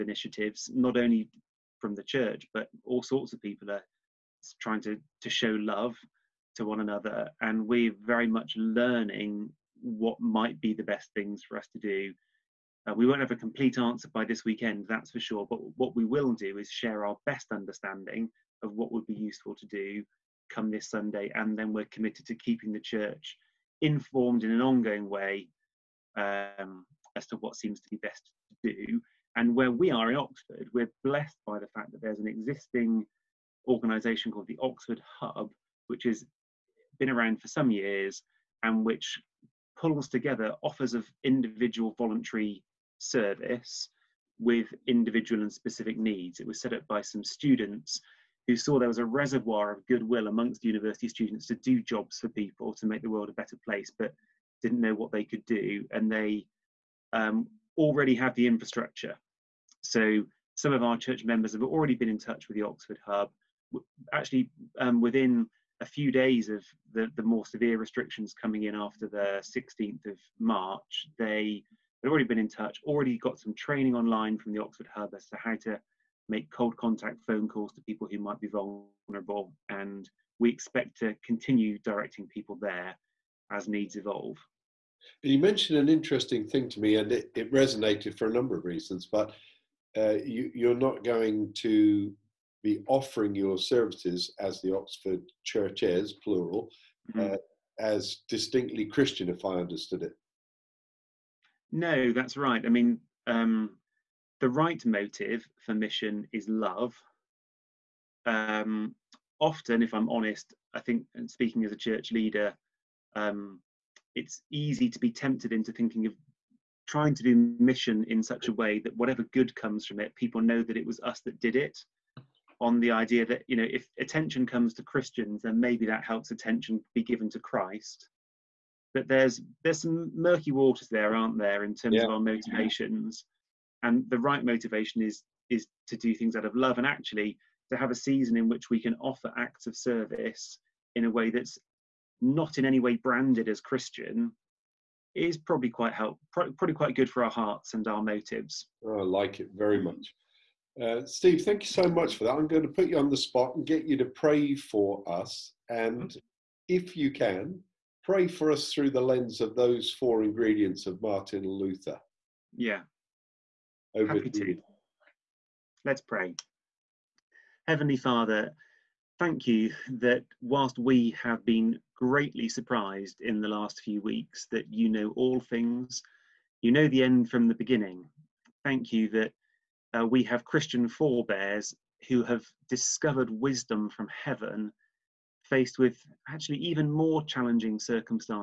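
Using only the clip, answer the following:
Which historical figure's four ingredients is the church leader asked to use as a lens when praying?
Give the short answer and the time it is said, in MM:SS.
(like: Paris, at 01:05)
Martin Luther, at 02:41.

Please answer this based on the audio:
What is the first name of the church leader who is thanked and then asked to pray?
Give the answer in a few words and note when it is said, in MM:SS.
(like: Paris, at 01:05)
Steve, at 02:31.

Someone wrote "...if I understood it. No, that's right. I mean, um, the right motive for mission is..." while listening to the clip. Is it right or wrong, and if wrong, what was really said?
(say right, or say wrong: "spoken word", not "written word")
right.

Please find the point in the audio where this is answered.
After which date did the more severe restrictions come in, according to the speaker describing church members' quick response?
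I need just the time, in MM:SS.
01:09.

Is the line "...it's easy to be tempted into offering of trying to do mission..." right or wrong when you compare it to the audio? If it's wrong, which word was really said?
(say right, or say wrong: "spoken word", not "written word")
wrong: "thinking", not "offering".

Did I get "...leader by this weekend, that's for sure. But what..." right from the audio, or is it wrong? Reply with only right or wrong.
wrong.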